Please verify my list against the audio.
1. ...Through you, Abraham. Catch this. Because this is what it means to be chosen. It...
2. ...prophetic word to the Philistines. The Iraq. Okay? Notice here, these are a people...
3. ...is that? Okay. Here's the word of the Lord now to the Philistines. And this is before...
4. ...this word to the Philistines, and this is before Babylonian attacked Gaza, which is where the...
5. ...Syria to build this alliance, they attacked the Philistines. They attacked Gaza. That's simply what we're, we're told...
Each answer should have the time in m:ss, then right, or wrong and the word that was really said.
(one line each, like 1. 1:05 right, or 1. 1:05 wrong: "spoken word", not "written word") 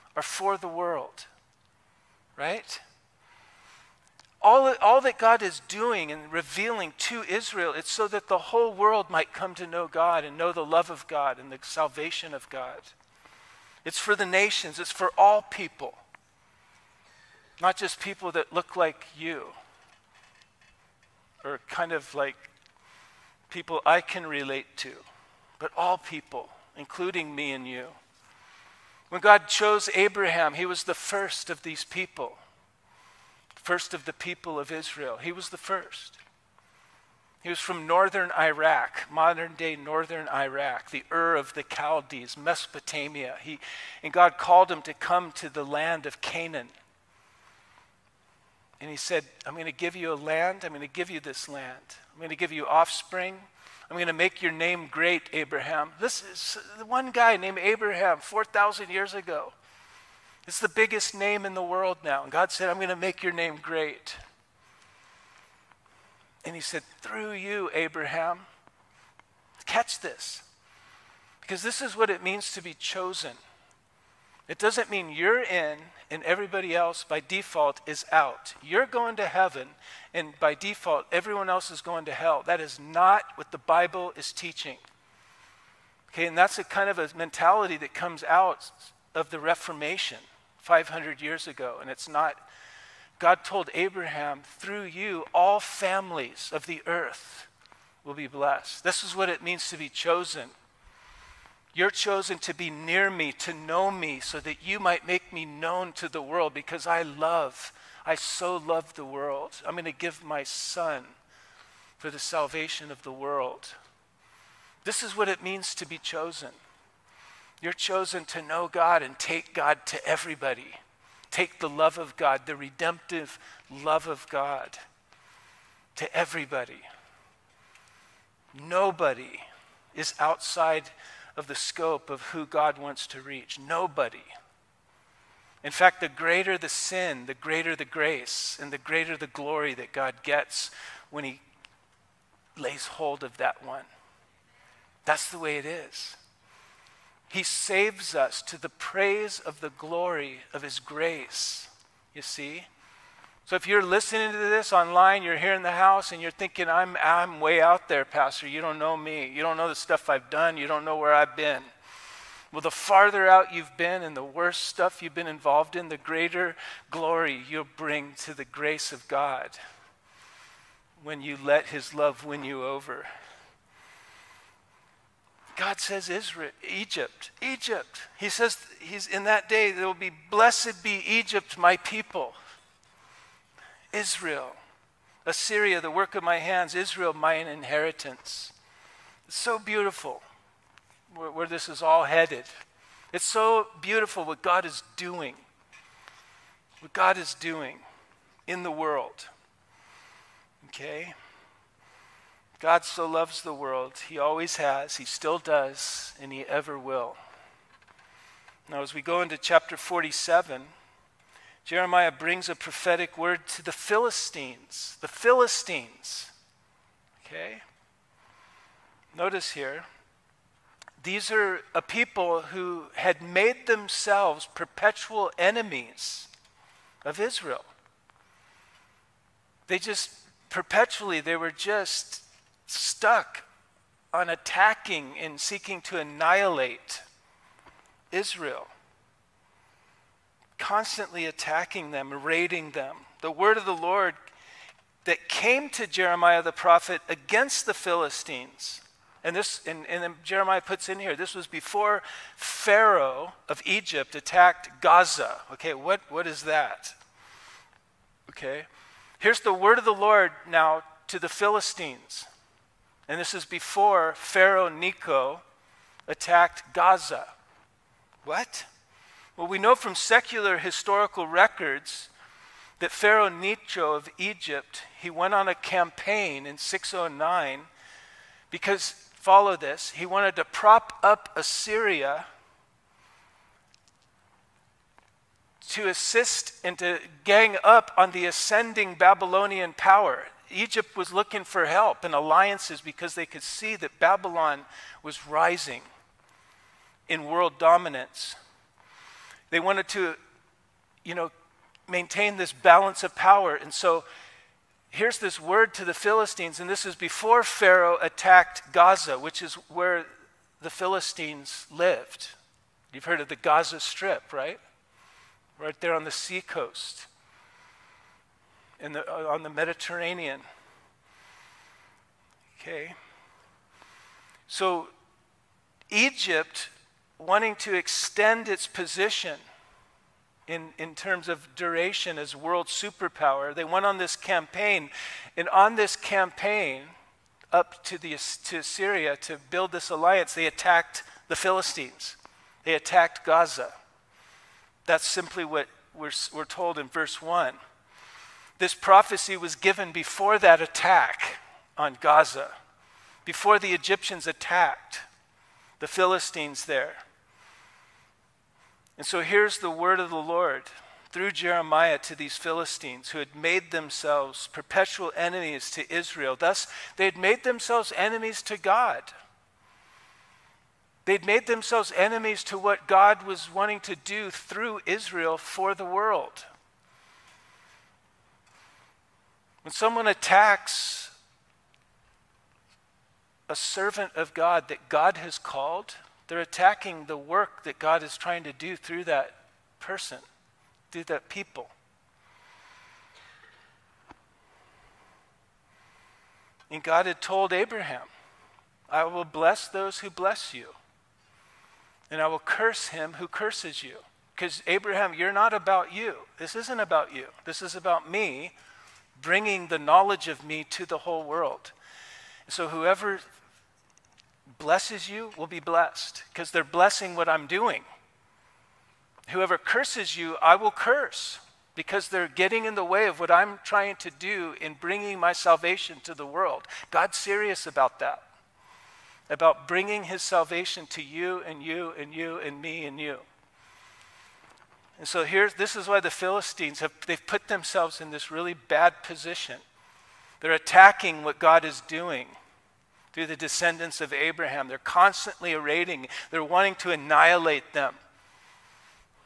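1. 1:07 right
2. 3:32 wrong: "Philistines", not "Iraq"
3. 4:16 right
4. 5:05 wrong: "Pharaoh", not "Babylonian"
5. 5:38 right.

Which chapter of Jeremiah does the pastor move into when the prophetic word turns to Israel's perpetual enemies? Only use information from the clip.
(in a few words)
47.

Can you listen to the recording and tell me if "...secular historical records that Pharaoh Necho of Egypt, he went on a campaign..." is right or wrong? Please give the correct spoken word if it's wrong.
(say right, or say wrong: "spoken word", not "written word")
right.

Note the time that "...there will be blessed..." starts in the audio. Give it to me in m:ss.
2:59.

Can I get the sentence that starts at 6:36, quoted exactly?
And God had told Abraham, I will bless those who bless you, and I will curse him who curses you.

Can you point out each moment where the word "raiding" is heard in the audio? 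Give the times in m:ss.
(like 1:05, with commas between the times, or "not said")
4:02, 7:25.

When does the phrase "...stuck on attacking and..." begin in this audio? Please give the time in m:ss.
3:52.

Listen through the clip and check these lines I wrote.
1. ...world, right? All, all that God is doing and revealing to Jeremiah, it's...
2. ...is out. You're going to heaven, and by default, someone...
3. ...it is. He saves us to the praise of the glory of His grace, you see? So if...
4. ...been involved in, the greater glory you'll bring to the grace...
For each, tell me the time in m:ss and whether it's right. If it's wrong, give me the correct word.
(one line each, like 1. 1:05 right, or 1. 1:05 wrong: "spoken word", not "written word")
1. 0:00 wrong: "Israel", not "Jeremiah"
2. 1:17 wrong: "everyone", not "someone"
3. 2:25 right
4. 2:45 right.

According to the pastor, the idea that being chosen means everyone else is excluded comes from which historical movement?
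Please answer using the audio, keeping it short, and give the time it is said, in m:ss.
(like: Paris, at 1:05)
The Reformation, at 1:29.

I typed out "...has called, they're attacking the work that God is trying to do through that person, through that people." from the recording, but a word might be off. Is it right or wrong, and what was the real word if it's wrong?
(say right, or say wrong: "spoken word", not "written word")
right.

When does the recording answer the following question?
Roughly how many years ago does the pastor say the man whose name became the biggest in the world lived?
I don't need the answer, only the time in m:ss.
0:58.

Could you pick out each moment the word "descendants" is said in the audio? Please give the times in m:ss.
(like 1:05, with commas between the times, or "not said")
7:23.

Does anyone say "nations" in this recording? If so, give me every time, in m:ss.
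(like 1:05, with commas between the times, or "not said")
0:14.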